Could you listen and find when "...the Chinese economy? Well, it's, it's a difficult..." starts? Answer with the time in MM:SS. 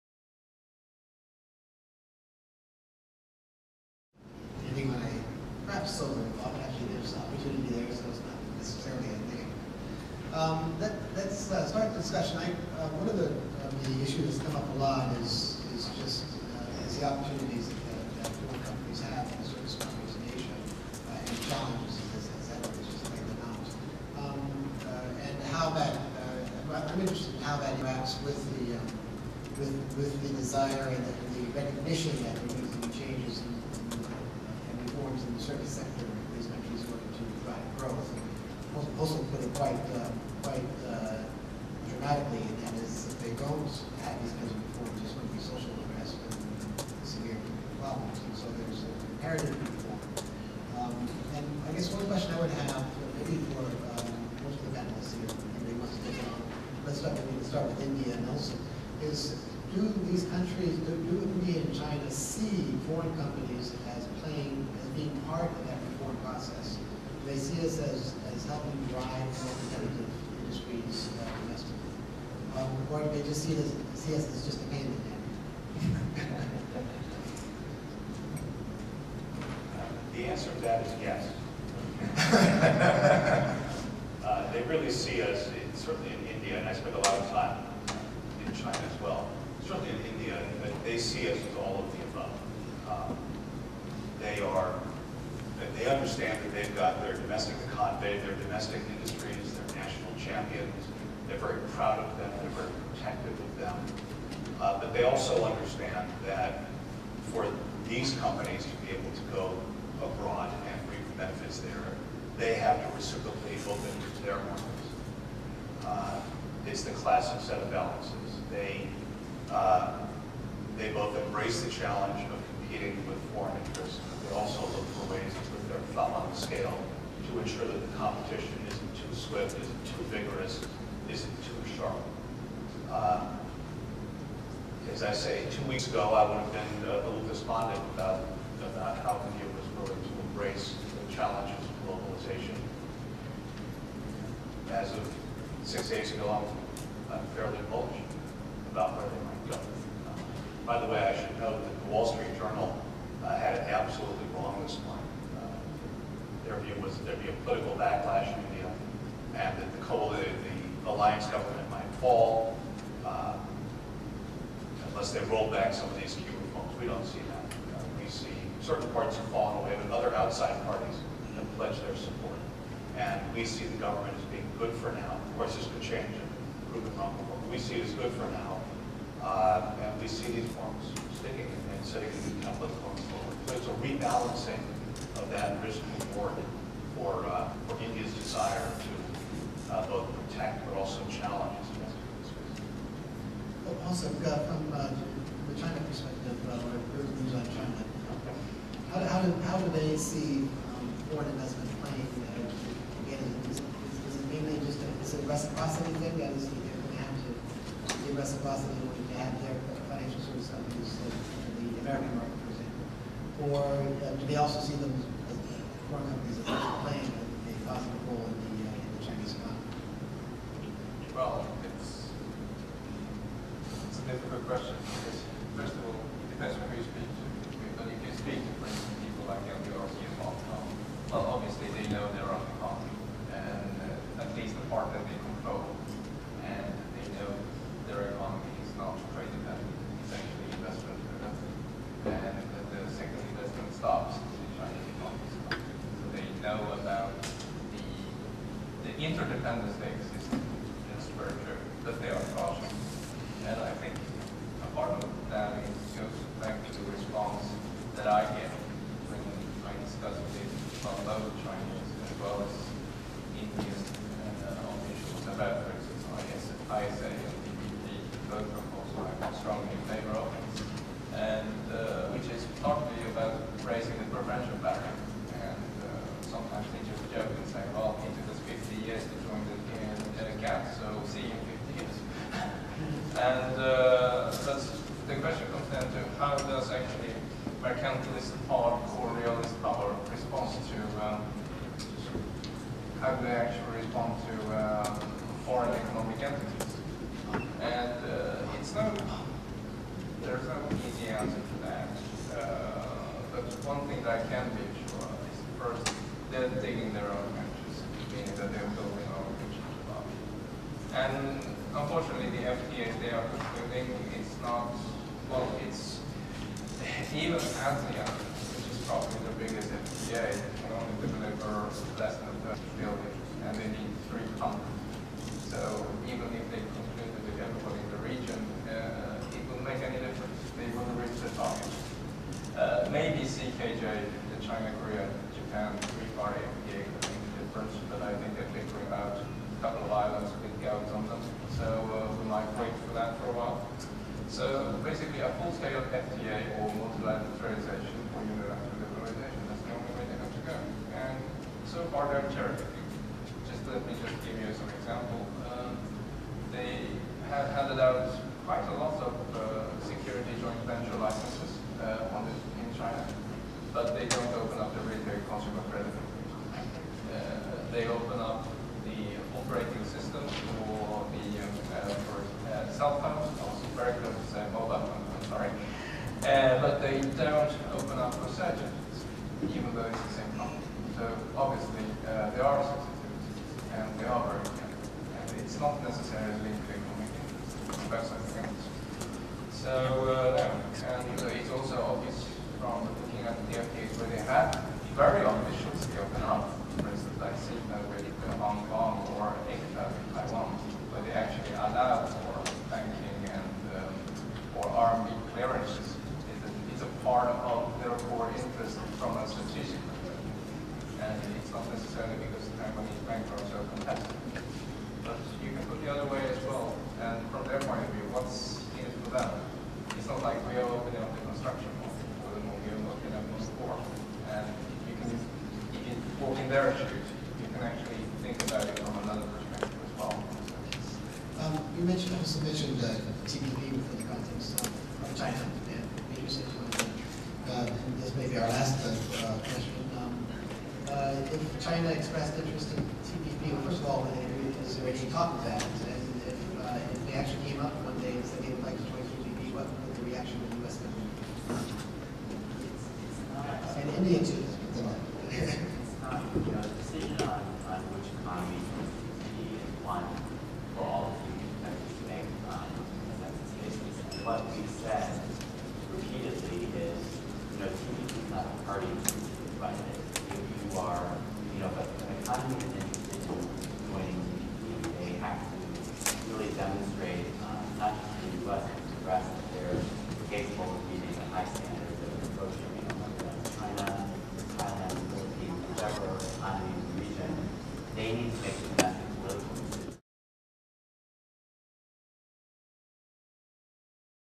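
03:38.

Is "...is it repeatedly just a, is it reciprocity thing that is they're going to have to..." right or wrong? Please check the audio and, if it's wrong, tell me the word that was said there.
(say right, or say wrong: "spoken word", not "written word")
wrong: "mainly", not "repeatedly".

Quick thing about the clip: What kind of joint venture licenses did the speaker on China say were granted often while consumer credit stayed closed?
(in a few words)
security.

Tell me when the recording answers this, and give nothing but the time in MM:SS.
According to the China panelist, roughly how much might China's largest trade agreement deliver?
05:21.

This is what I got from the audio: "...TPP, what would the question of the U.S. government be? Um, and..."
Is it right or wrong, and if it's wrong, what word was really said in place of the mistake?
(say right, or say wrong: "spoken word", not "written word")
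wrong: "reaction", not "question".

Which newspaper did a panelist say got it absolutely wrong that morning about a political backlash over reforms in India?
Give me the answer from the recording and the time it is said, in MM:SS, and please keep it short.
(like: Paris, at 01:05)
Wall Street Journal, at 02:31.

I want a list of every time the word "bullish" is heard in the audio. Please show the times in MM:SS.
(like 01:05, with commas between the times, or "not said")
02:27.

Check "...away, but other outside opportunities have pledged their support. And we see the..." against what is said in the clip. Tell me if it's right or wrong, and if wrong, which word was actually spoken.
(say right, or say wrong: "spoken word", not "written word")
wrong: "parties", not "opportunities".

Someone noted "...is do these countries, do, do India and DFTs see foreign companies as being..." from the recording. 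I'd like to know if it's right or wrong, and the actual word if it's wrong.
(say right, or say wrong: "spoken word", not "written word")
wrong: "China", not "DFTs".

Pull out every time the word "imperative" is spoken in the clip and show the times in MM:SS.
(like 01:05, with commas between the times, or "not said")
00:49.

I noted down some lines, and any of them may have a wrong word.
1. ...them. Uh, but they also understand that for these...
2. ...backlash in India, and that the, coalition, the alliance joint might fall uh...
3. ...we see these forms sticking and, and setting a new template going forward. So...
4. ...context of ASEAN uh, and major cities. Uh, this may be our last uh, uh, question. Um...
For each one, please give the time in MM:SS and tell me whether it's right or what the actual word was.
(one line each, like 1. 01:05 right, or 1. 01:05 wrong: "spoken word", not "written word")
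1. 01:43 right
2. 02:37 wrong: "government", not "joint"
3. 03:00 right
4. 07:14 wrong: "China", not "ASEAN".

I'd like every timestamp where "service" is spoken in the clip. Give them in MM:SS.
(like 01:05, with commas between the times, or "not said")
00:19, 00:35, 03:30.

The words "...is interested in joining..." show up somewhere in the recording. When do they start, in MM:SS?
07:52.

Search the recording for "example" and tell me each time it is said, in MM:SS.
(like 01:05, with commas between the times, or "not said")
03:32, 05:54.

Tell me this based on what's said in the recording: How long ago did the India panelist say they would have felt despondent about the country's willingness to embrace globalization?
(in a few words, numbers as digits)
two weeks ago.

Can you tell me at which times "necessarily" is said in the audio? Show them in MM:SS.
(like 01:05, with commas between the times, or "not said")
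00:08, 06:25.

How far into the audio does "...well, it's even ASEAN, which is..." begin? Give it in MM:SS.
05:15.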